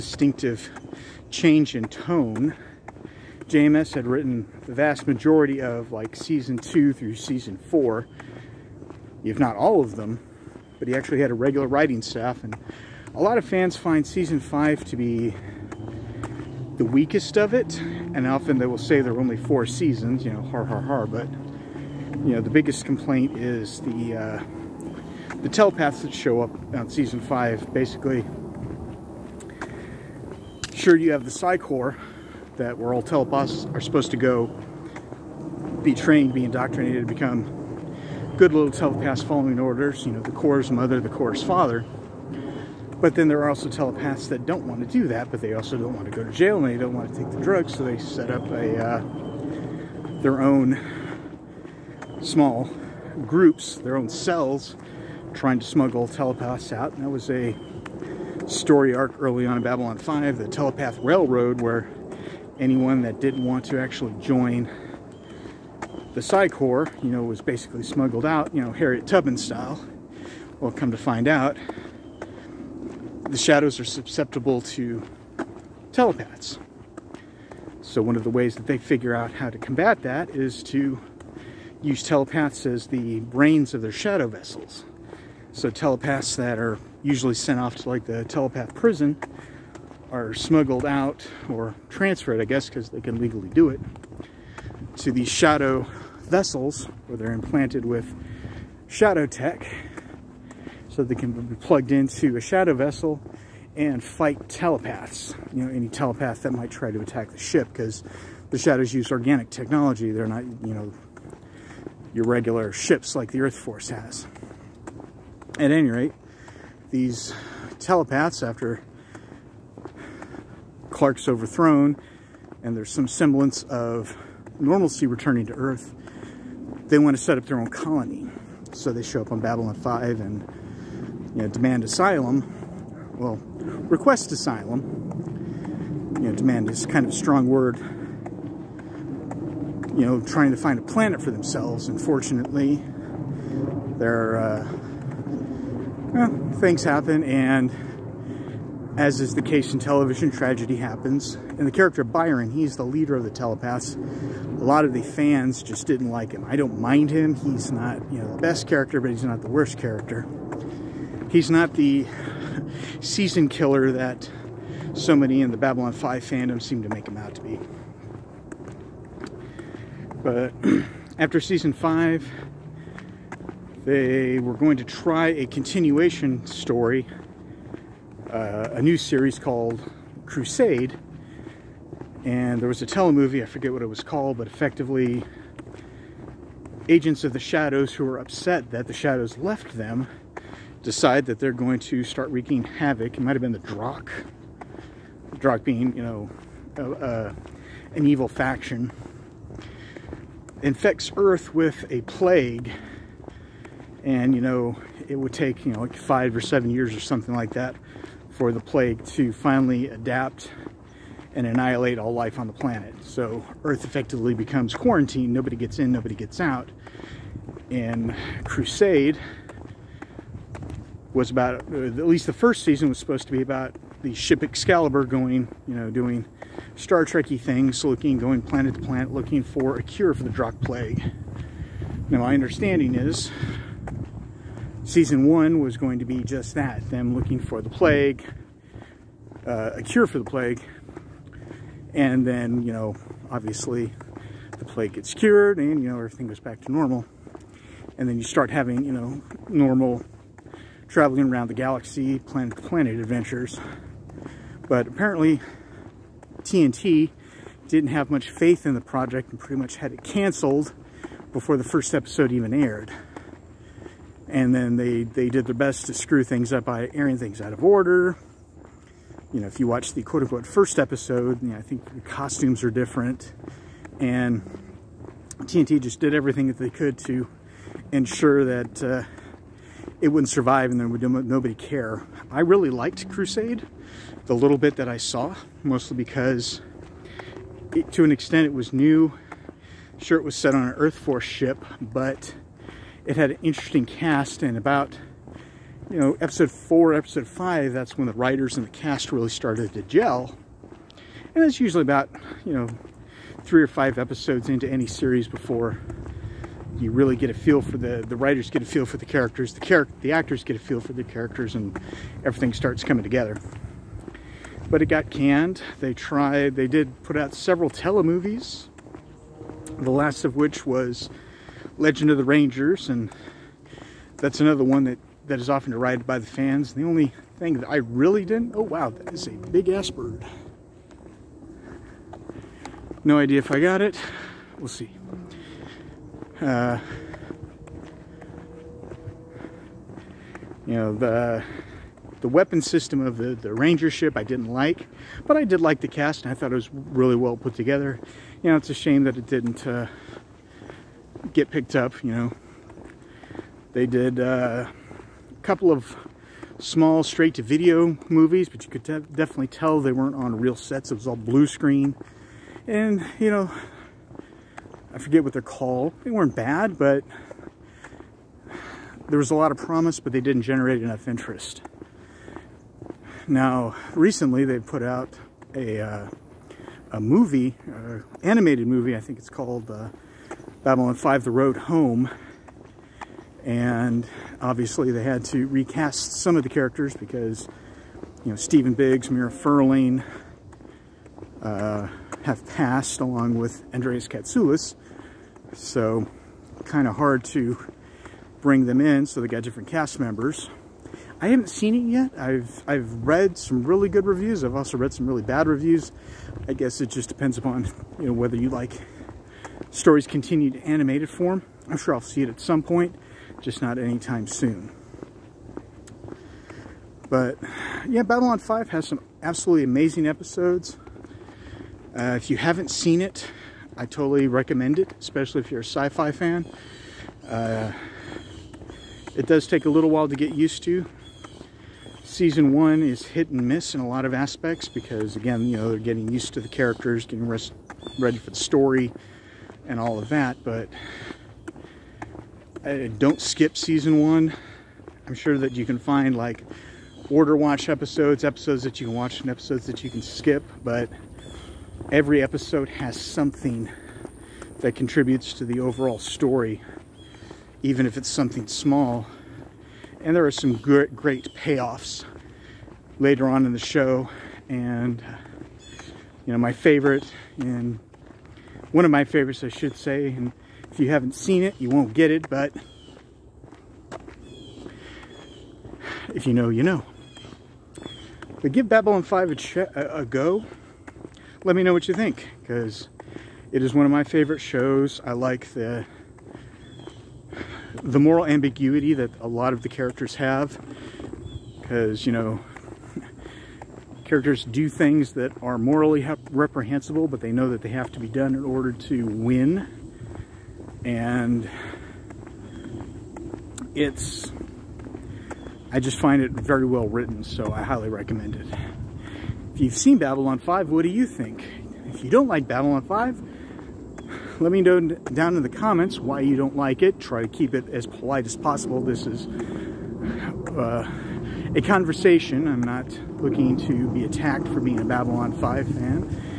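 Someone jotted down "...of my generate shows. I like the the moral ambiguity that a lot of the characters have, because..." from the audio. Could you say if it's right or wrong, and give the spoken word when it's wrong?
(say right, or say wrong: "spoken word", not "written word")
wrong: "favorite", not "generate".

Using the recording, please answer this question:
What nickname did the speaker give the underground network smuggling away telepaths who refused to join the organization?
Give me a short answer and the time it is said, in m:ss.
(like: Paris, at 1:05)
telepath railroad, at 1:00.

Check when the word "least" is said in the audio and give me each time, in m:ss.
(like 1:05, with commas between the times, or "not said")
3:42.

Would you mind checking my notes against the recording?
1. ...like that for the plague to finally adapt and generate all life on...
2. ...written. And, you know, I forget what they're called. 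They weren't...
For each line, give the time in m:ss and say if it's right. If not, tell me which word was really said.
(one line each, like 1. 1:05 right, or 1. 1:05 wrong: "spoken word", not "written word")
1. 3:27 wrong: "annihilate", not "generate"
2. 6:01 wrong: "screen", not "written".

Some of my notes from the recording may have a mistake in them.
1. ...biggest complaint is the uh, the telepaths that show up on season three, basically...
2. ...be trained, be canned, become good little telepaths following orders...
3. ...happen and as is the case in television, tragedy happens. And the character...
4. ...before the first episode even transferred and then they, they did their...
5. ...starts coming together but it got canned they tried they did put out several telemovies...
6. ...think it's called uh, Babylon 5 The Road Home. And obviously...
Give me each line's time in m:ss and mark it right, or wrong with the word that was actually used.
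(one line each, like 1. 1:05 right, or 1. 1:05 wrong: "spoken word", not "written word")
1. 0:22 wrong: "five", not "three"
2. 0:35 wrong: "indoctrinated", not "canned"
3. 2:26 right
4. 4:21 wrong: "aired", not "transferred"
5. 5:12 right
6. 6:18 right.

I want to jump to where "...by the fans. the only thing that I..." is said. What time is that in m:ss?
5:26.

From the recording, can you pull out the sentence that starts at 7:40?
And there are some great, great payoffs later on in the show.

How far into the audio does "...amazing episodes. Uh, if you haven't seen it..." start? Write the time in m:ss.
6:59.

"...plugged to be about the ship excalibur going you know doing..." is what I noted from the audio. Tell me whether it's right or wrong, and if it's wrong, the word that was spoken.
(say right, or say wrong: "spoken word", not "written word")
wrong: "supposed", not "plugged".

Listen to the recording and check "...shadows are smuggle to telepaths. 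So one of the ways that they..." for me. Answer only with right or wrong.
wrong.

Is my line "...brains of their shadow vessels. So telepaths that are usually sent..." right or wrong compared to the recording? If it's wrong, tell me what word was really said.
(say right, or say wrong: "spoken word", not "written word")
right.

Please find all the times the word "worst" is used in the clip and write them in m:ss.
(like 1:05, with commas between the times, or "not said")
2:39.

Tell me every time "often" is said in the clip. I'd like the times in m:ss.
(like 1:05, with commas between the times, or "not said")
0:18, 5:25.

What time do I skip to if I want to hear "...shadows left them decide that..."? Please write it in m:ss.
3:08.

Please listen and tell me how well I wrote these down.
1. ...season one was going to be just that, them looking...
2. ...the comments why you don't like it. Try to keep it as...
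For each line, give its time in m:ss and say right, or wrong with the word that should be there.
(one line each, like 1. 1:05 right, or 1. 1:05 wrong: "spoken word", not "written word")
1. 3:54 right
2. 8:35 right.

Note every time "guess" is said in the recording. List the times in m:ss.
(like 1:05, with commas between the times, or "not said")
1:32, 6:46.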